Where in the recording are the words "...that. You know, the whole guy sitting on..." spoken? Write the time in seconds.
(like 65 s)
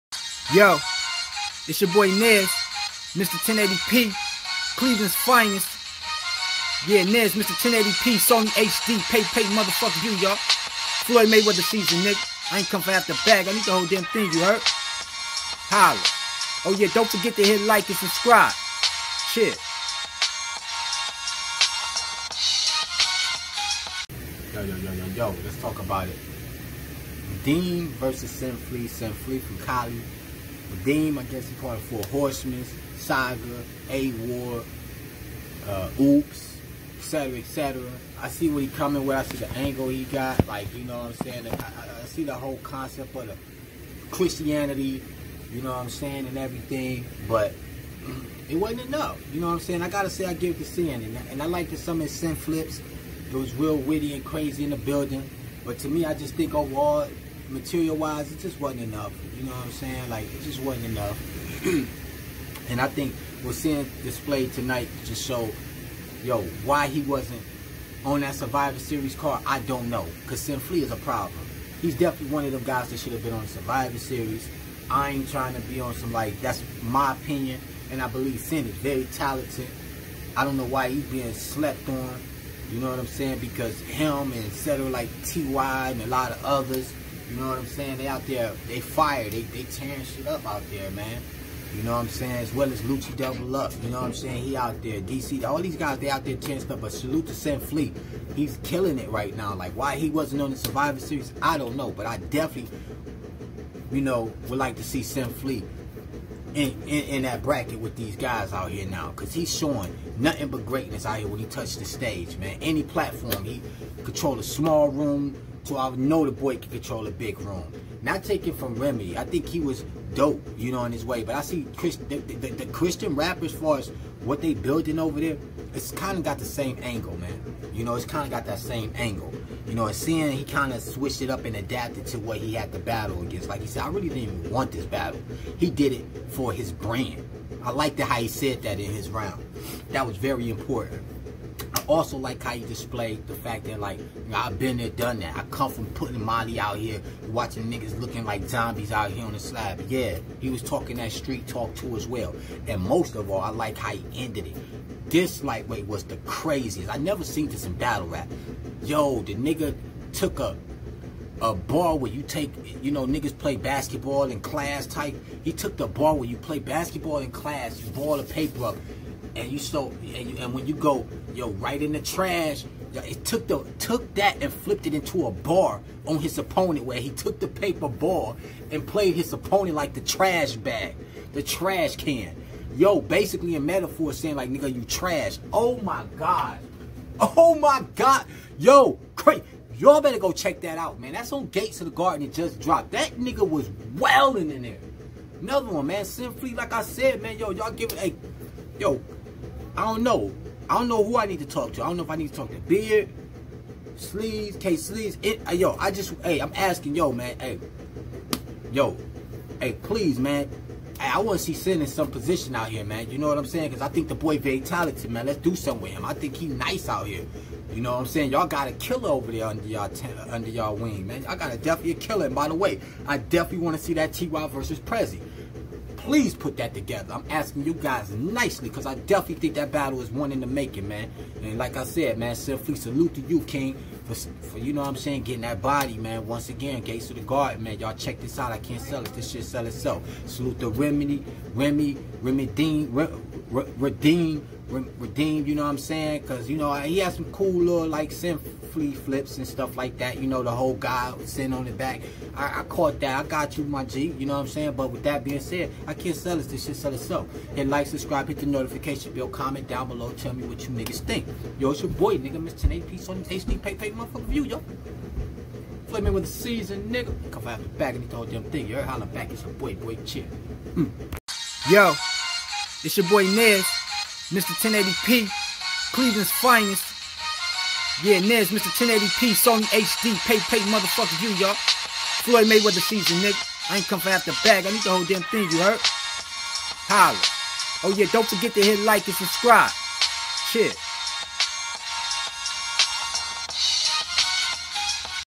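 249 s.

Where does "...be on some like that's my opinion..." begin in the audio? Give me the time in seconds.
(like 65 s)
75 s.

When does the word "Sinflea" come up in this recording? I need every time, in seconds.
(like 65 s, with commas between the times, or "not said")
28 s, 70 s.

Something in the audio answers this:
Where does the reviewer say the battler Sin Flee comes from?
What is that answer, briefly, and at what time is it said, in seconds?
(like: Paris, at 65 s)
Cali, at 29 s.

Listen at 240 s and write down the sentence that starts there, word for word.
Salute to Remedy, Remy, Remy Dean, Redeem, redeemed, you know what I'm saying?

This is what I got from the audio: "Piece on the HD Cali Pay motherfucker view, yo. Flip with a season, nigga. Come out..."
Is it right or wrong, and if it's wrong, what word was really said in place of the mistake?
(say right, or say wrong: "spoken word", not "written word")
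wrong: "Pay", not "Cali".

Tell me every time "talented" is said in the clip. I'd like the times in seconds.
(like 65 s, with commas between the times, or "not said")
79 s, 214 s.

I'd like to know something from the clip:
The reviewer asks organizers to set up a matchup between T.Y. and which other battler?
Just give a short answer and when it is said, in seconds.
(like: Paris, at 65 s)
Prezi, at 224 s.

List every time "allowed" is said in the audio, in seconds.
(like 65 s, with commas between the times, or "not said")
not said.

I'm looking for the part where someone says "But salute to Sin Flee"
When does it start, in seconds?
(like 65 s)
96 s.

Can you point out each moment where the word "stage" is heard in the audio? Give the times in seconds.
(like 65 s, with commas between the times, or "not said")
111 s.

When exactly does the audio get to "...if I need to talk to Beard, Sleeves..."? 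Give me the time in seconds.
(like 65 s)
202 s.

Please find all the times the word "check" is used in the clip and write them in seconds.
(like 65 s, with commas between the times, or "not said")
190 s, 237 s.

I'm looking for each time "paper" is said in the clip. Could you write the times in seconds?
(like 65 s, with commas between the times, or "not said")
168 s, 177 s.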